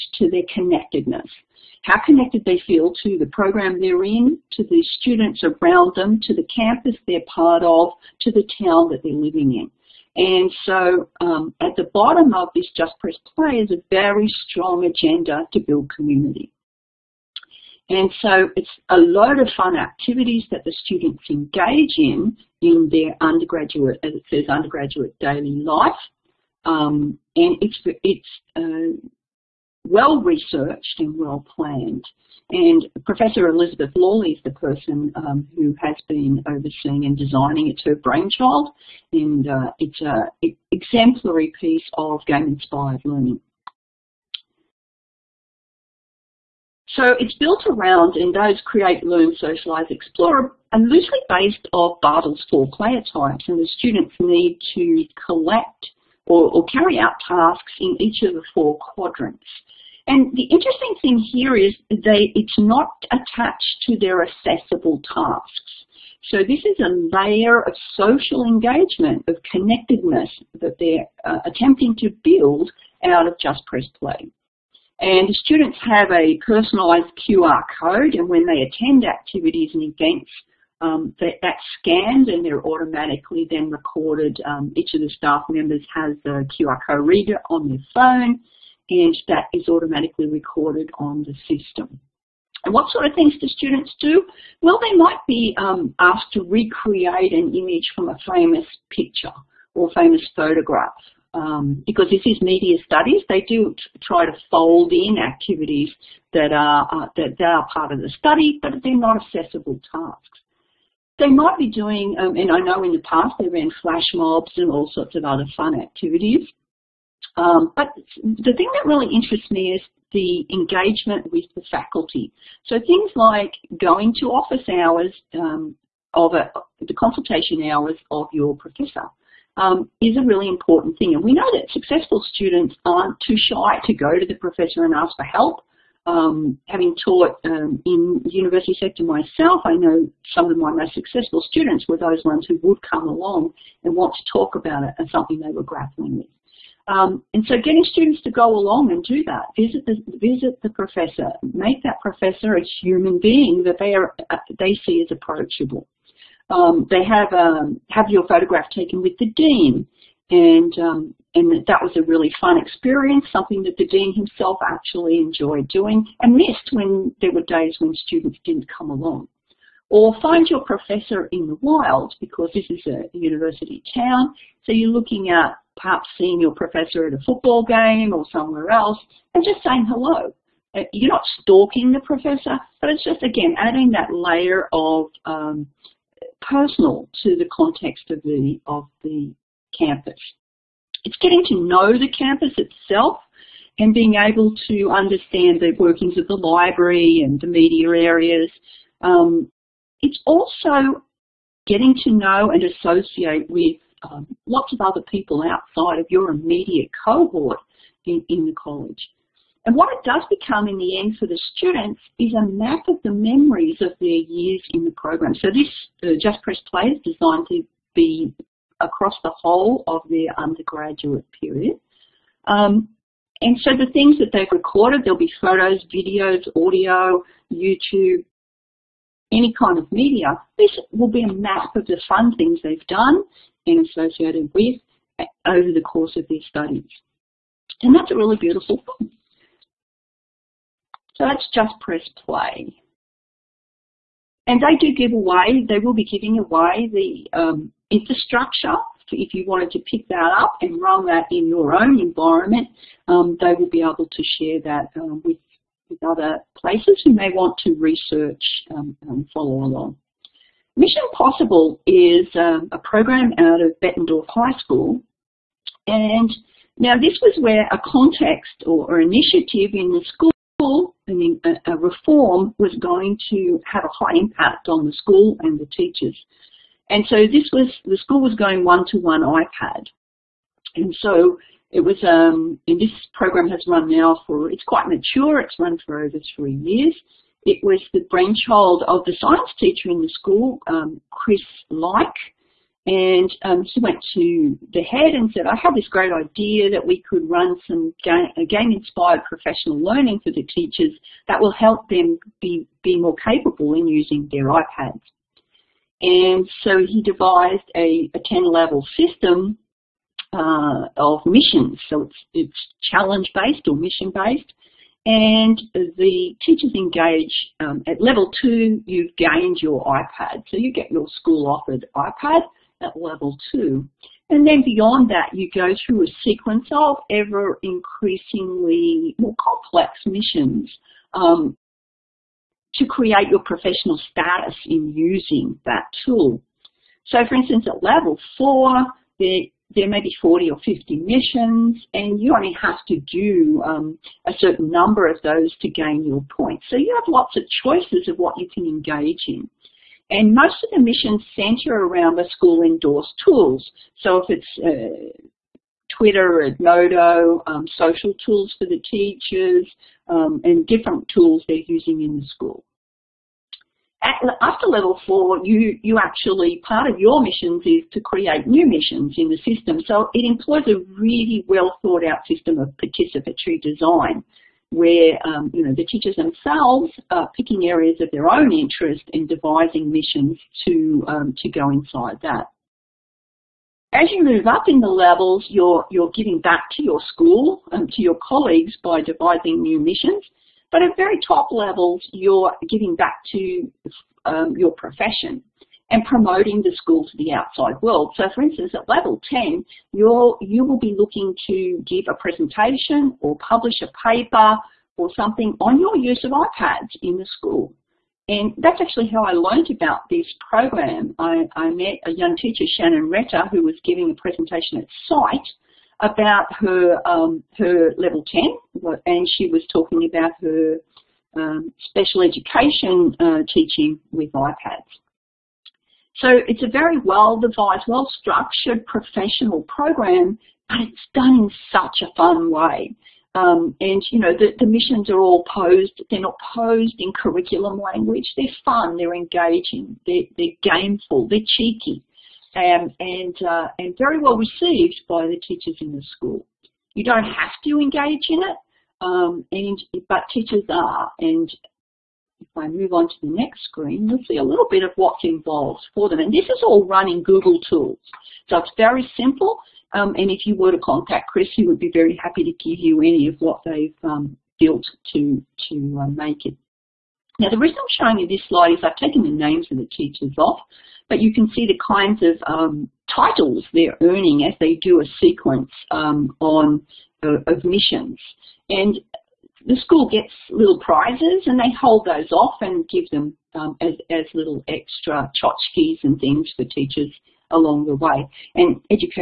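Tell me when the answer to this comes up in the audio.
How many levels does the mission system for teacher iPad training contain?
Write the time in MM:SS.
05:08.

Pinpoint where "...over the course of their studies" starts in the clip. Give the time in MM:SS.
03:55.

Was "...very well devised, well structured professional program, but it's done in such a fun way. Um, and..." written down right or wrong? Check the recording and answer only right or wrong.
right.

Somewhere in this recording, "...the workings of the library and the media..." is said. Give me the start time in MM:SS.
03:15.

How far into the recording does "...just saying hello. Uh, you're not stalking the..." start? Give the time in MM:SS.
02:59.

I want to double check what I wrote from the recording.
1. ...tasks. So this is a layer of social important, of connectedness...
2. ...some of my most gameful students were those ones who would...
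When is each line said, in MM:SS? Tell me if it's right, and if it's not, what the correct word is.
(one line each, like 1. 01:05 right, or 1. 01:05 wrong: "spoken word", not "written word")
1. 01:05 wrong: "engagement", not "important"
2. 02:20 wrong: "successful", not "gameful".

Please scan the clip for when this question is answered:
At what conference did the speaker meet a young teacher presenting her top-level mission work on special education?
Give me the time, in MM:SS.
06:55.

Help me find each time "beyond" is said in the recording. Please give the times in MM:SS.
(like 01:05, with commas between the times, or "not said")
05:24.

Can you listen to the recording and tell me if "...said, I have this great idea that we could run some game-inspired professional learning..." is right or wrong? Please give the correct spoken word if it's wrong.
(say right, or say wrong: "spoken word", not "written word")
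right.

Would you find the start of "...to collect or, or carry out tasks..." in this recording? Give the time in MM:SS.
00:54.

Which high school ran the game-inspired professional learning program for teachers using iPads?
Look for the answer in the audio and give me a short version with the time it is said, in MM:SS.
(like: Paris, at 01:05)
Bettendorf High School, at 04:23.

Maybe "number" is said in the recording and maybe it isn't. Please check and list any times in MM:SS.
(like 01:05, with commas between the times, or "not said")
05:44.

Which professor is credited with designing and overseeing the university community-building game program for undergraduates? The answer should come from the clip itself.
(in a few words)
Elizabeth Lawley.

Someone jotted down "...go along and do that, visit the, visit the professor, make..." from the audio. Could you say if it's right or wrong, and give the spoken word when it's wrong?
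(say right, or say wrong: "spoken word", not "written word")
right.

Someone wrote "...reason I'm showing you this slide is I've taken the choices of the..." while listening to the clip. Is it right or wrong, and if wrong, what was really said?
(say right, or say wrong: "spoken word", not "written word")
wrong: "names", not "choices".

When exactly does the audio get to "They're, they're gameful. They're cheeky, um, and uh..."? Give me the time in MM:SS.
07:20.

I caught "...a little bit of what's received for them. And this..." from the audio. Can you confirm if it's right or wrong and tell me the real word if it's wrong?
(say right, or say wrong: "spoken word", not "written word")
wrong: "involved", not "received".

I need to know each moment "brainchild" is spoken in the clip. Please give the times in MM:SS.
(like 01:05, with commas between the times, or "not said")
00:37, 04:48.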